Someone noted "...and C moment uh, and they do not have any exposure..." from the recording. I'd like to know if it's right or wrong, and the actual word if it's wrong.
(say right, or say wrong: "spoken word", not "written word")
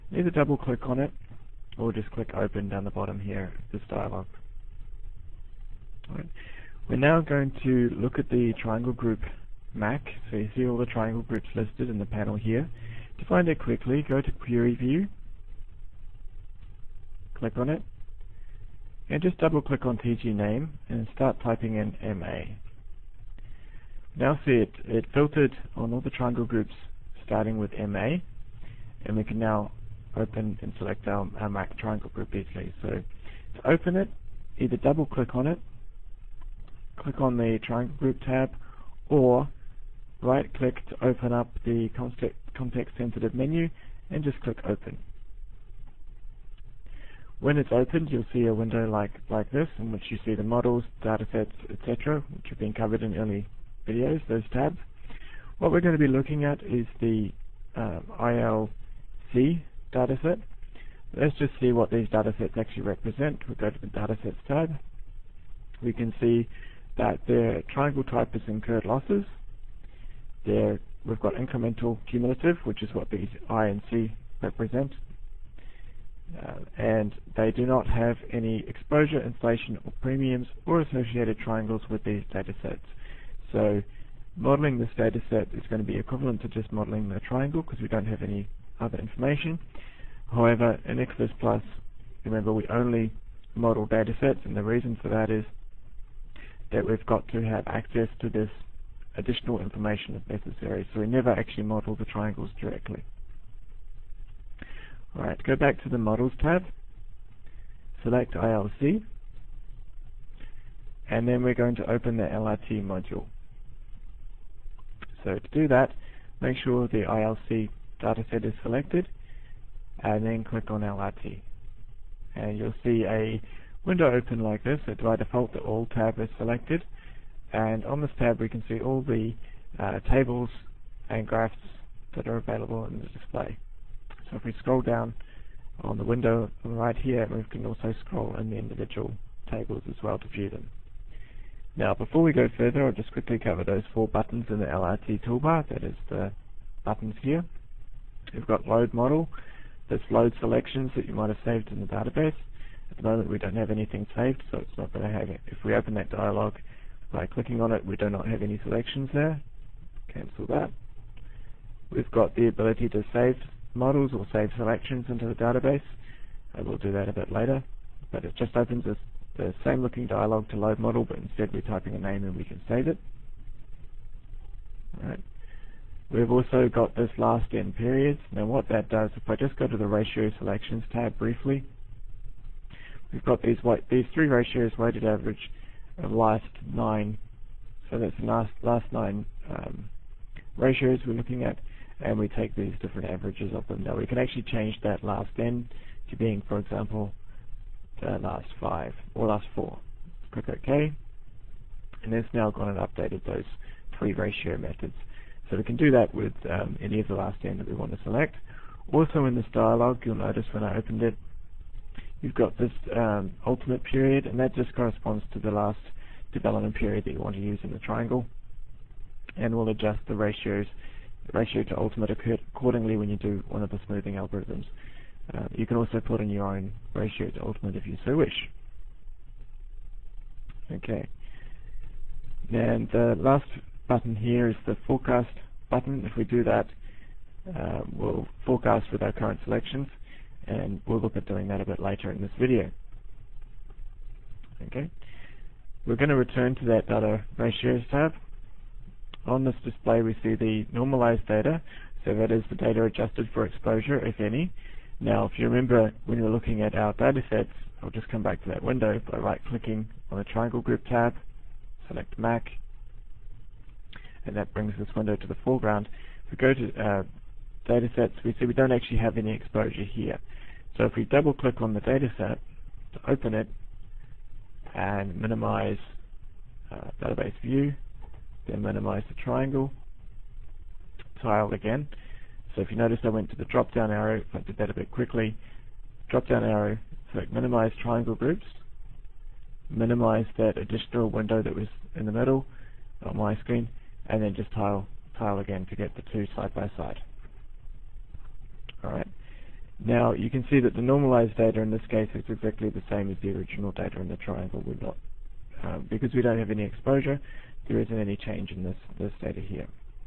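wrong: "represent", not "moment".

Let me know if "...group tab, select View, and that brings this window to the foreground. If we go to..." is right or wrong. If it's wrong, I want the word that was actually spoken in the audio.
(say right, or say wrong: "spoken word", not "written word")
wrong: "Mac", not "View".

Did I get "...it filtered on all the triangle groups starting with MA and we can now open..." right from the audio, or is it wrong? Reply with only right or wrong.
right.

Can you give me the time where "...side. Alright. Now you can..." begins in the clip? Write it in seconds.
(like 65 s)
296 s.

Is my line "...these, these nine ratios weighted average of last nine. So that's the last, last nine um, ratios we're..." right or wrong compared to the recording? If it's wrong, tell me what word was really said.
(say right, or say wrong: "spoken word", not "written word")
wrong: "three", not "nine".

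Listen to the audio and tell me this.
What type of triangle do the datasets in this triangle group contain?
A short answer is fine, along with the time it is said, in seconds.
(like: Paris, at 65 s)
Incurred losses, at 68 s.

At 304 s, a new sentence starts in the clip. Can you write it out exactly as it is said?
We're not, um, because we don't have any exposure, there isn't any change in this, this data here.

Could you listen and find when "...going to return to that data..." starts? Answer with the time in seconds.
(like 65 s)
245 s.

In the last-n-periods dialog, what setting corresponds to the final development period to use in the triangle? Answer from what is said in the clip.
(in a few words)
Ultimate period.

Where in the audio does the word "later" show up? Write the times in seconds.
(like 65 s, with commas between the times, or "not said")
167 s, 241 s.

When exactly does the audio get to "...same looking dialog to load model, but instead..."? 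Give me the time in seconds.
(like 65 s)
169 s.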